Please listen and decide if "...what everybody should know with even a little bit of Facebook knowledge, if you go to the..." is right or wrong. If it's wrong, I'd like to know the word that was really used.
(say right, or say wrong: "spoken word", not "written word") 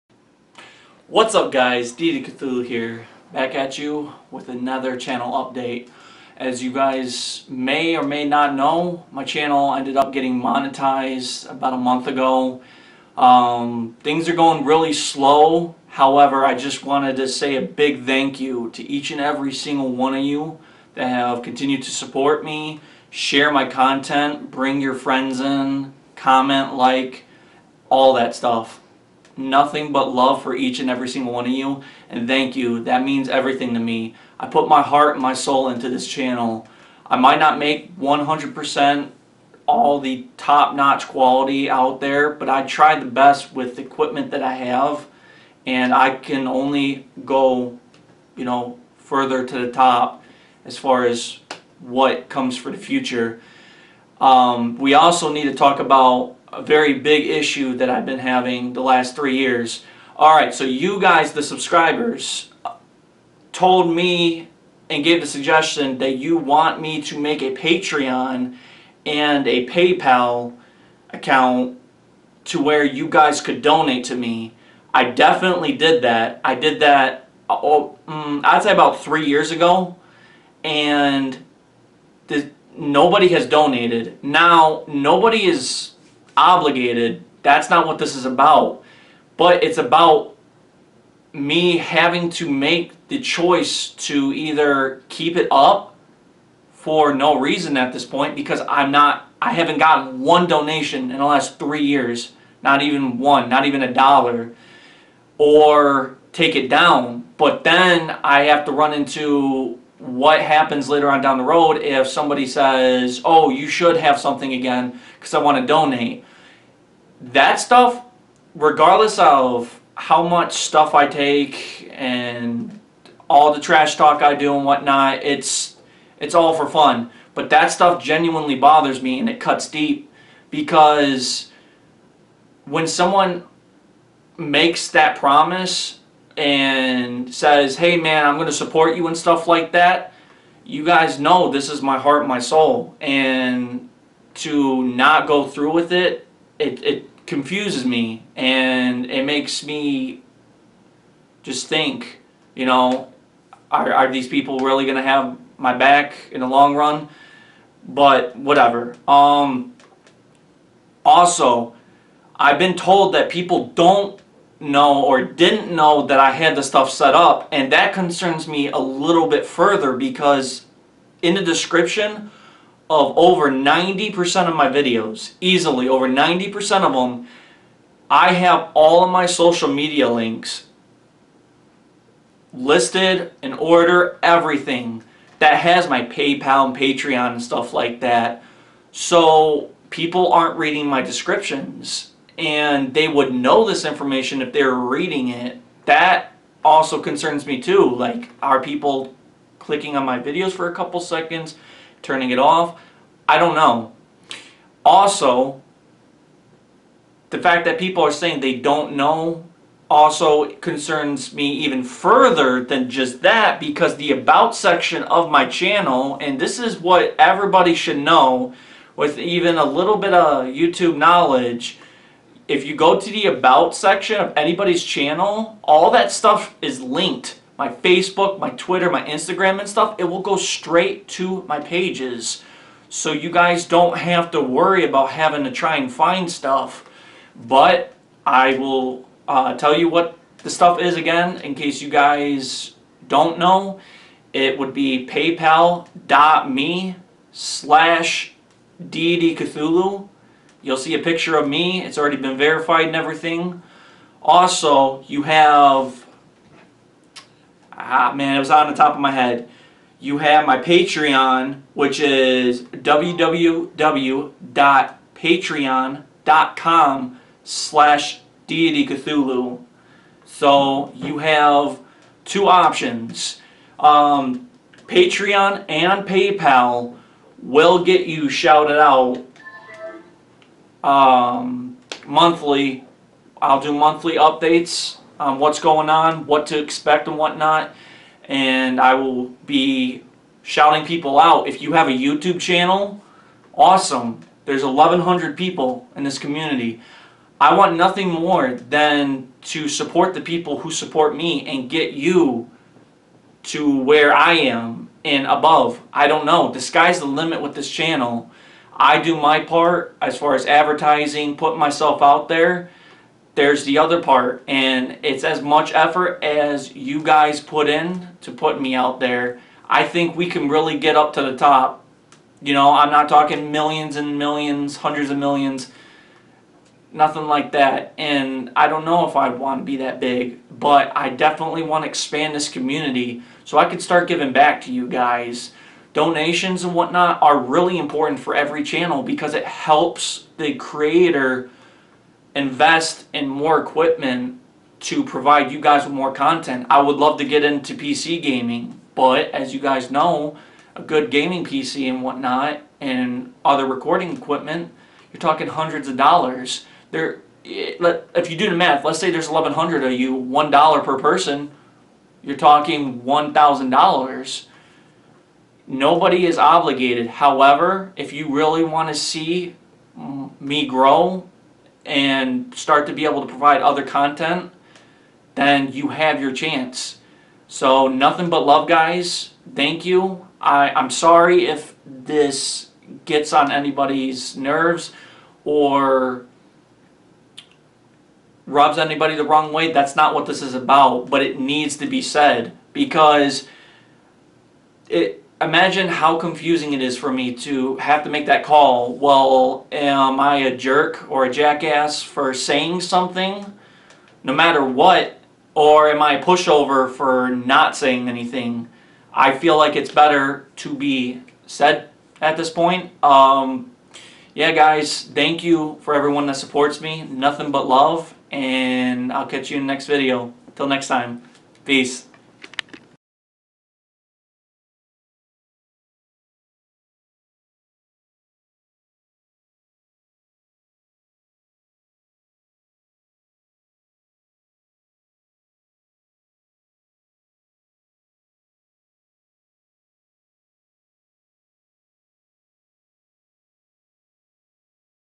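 wrong: "YouTube", not "Facebook".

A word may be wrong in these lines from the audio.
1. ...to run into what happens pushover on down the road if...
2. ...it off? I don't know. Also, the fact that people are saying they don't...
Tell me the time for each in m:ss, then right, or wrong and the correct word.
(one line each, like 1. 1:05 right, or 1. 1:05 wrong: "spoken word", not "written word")
1. 1:48 wrong: "later", not "pushover"
2. 3:22 right.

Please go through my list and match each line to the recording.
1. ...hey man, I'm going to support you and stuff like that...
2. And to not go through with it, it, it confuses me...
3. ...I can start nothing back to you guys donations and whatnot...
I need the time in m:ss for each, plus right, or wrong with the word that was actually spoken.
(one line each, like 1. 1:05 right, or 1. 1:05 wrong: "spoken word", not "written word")
1. 2:17 right
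2. 2:22 right
3. 5:33 wrong: "giving", not "nothing".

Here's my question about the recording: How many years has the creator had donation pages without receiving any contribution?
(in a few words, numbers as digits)
3 years.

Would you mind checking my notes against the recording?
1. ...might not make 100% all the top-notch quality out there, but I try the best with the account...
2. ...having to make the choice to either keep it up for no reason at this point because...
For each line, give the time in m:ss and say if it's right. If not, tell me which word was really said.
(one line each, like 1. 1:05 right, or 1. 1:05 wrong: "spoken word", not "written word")
1. 0:37 wrong: "equipment", not "account"
2. 1:31 right.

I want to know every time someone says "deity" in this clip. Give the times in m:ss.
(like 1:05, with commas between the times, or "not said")
0:01, 4:08, 4:28.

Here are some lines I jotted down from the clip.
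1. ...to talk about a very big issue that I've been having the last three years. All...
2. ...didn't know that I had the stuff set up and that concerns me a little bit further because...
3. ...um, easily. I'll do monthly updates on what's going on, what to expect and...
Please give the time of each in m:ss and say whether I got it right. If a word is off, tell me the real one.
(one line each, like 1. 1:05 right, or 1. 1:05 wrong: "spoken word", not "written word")
1. 0:55 right
2. 2:45 right
3. 4:40 wrong: "monthly", not "easily".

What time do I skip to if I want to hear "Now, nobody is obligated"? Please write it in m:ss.
1:24.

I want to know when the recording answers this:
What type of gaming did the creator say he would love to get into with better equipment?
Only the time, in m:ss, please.
5:47.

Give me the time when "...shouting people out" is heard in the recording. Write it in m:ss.
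4:50.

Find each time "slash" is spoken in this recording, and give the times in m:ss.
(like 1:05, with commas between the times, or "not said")
4:07, 4:27.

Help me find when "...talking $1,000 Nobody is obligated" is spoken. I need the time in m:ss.
6:02.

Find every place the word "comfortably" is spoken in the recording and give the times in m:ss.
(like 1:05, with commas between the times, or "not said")
not said.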